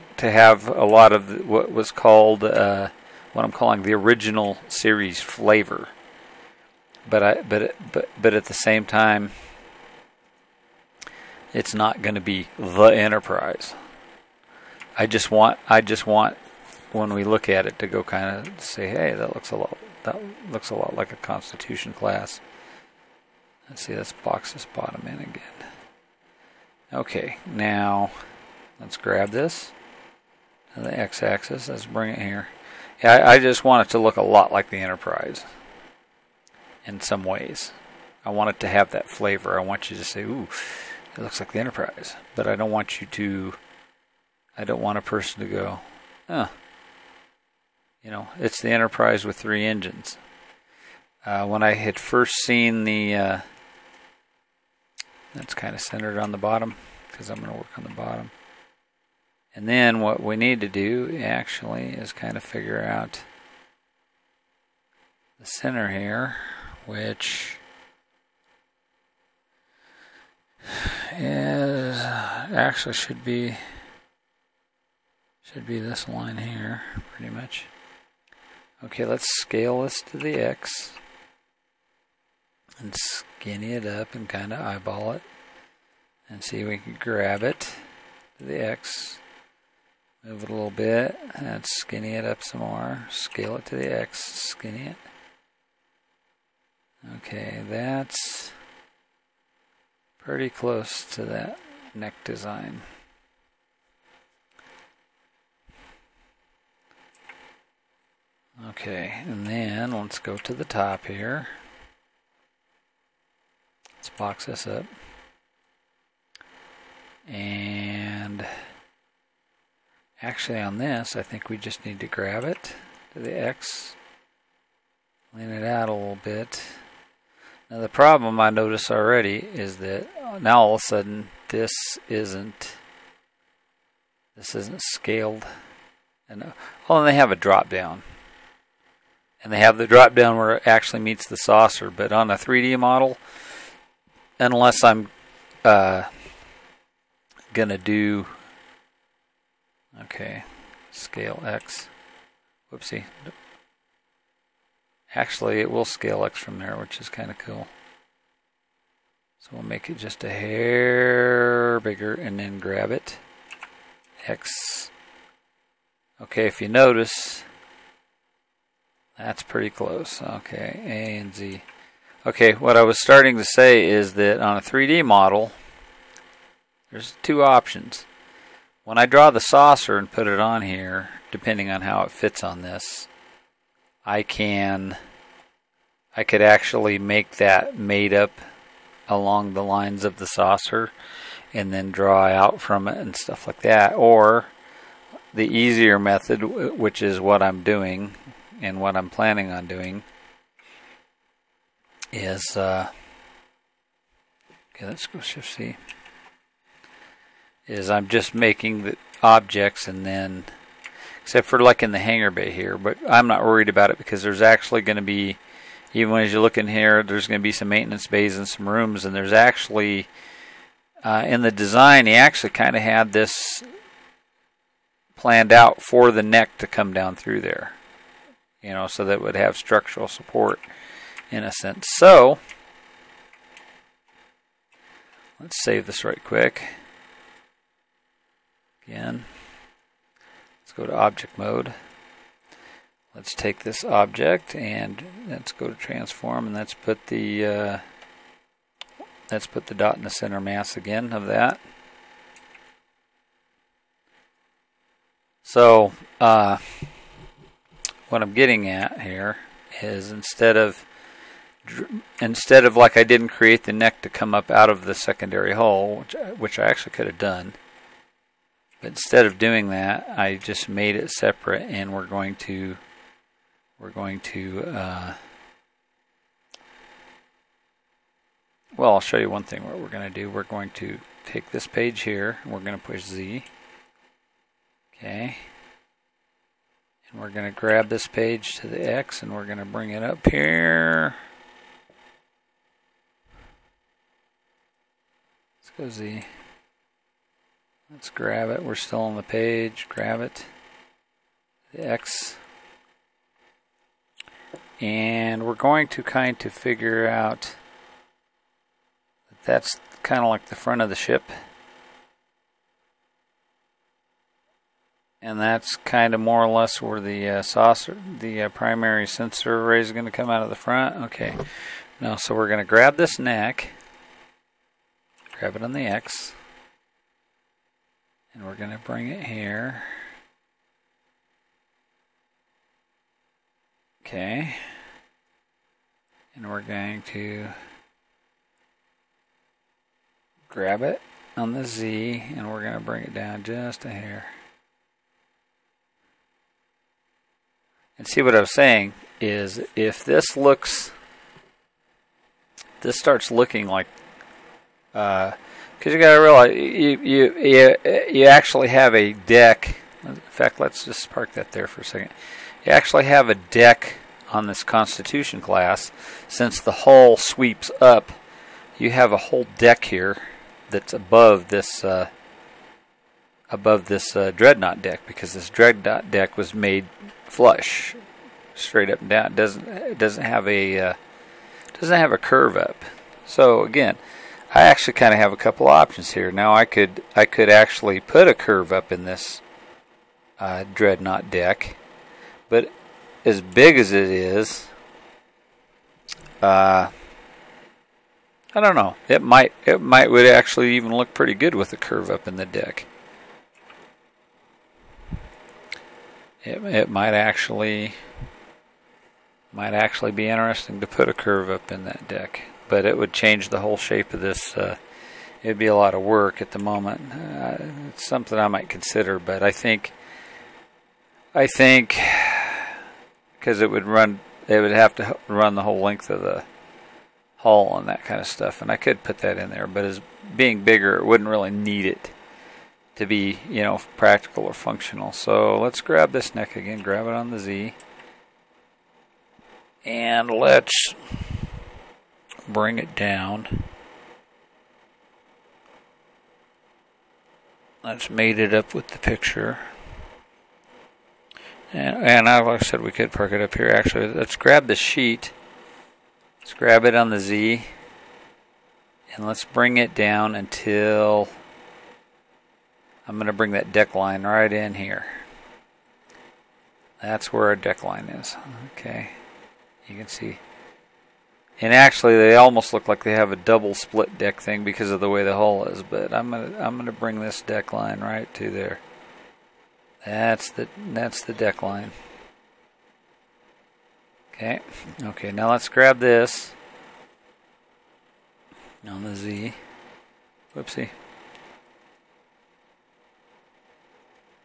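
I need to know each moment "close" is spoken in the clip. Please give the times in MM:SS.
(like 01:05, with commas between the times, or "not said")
01:40, 02:49.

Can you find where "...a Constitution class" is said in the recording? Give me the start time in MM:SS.
00:21.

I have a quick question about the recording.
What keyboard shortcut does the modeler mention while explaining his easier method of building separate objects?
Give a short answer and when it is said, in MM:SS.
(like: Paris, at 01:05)
Shift C, at 03:25.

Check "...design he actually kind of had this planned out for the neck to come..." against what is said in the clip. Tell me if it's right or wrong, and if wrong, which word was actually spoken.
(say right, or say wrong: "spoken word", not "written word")
right.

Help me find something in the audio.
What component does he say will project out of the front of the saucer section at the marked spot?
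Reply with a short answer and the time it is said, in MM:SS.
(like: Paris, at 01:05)
primary sensor array, at 05:18.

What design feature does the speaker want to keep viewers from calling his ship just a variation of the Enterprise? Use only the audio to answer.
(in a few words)
three engines.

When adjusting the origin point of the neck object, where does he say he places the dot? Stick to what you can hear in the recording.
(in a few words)
center mass.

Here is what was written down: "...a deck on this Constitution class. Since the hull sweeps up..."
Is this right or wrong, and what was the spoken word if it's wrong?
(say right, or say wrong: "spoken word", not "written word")
right.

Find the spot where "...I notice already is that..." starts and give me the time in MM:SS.
02:08.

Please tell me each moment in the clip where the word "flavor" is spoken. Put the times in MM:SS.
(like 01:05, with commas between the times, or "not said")
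00:05, 00:39.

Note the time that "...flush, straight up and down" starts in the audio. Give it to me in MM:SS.
06:17.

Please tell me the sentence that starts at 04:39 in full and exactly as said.
What we're going to do, we're going to take this page here, and we're going to push Z.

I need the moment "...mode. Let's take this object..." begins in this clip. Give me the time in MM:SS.
04:01.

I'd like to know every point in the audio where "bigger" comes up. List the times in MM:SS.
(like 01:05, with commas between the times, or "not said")
02:41, 07:10.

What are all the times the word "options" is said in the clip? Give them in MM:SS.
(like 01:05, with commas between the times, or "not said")
02:57, 06:25.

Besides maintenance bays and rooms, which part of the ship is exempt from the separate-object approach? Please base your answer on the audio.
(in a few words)
hangar bay.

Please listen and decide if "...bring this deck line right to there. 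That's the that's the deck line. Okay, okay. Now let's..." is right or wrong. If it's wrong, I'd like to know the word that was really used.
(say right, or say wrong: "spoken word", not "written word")
right.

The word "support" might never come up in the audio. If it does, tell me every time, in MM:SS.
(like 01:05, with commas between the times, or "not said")
03:50.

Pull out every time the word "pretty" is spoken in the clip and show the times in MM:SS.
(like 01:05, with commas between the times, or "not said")
01:17, 01:40, 02:49, 06:41.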